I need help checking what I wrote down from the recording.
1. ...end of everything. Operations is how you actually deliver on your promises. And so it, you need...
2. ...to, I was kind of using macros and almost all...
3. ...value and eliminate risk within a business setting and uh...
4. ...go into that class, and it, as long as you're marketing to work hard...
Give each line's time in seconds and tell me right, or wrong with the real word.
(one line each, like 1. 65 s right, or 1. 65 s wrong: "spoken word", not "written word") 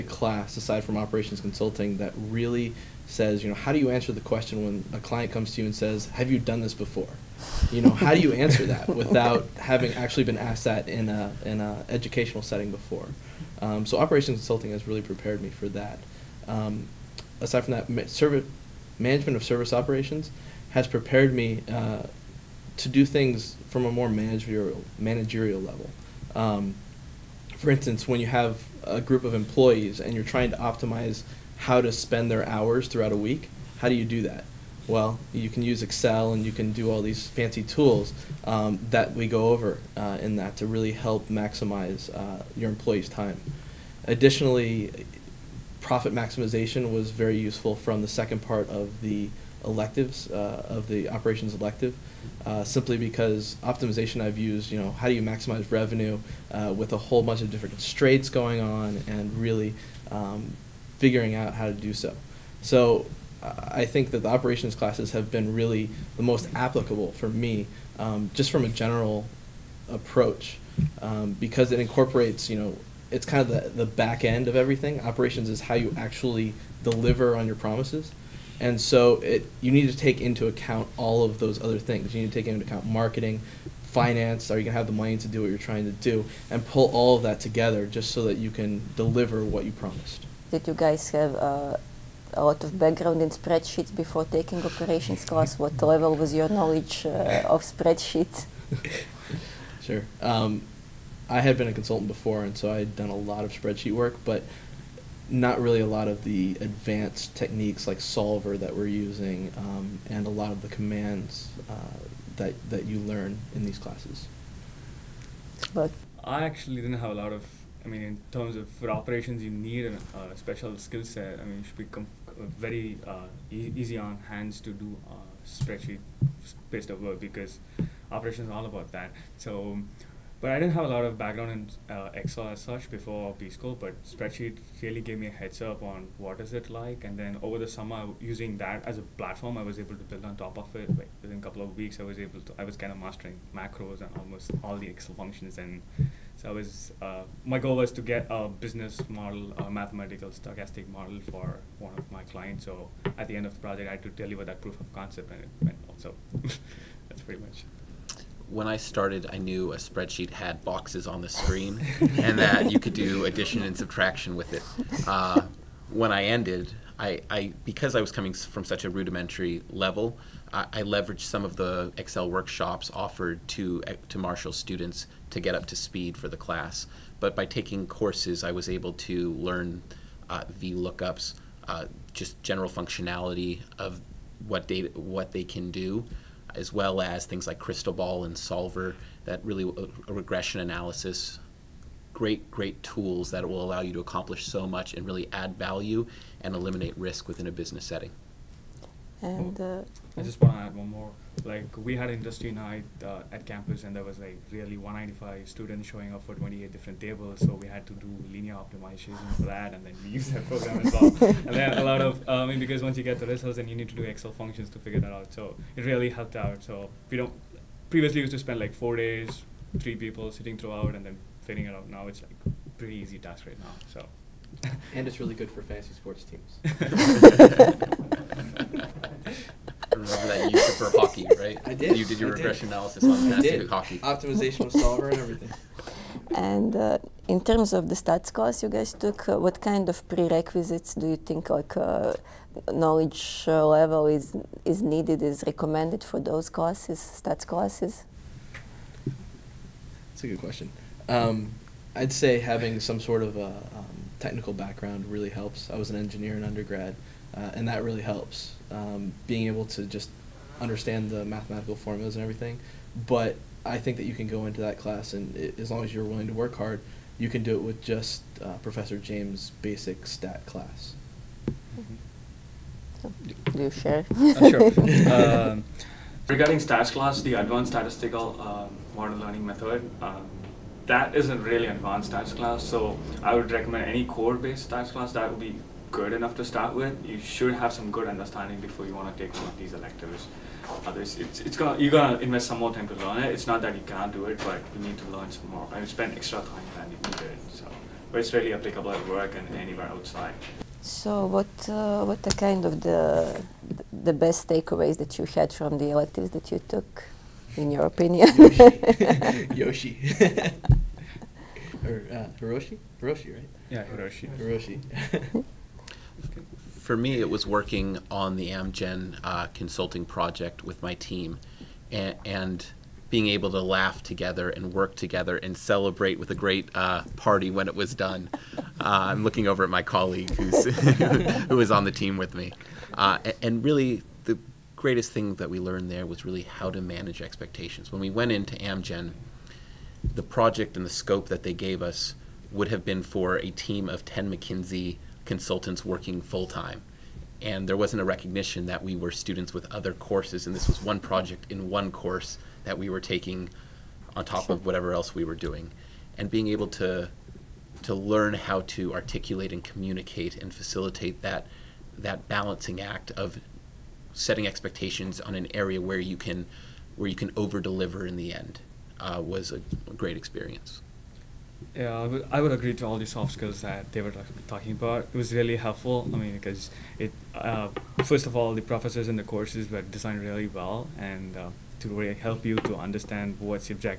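1. 74 s right
2. 142 s wrong: "mastering", not "using"
3. 195 s right
4. 264 s wrong: "willing", not "marketing".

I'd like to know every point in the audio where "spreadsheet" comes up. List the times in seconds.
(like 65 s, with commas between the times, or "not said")
93 s, 97 s, 103 s, 125 s, 134 s, 159 s.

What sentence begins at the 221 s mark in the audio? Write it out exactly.
Now it's like pretty easy task right now.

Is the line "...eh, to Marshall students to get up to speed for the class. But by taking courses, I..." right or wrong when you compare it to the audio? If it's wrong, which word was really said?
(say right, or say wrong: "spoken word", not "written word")
right.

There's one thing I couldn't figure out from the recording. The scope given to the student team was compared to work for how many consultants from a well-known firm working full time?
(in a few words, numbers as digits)
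10.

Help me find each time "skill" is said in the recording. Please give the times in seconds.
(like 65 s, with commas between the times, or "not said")
120 s, 373 s.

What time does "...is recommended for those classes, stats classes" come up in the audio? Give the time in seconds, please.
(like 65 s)
245 s.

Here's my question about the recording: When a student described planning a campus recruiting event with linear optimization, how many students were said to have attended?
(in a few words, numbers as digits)
195.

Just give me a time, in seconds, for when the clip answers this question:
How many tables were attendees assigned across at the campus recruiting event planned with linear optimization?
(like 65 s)
206 s.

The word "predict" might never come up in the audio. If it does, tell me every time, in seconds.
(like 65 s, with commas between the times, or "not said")
not said.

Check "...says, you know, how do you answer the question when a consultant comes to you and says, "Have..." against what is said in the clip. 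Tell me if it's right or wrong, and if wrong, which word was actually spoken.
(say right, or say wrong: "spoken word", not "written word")
wrong: "client", not "consultant".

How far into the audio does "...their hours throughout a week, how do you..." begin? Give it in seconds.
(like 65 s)
32 s.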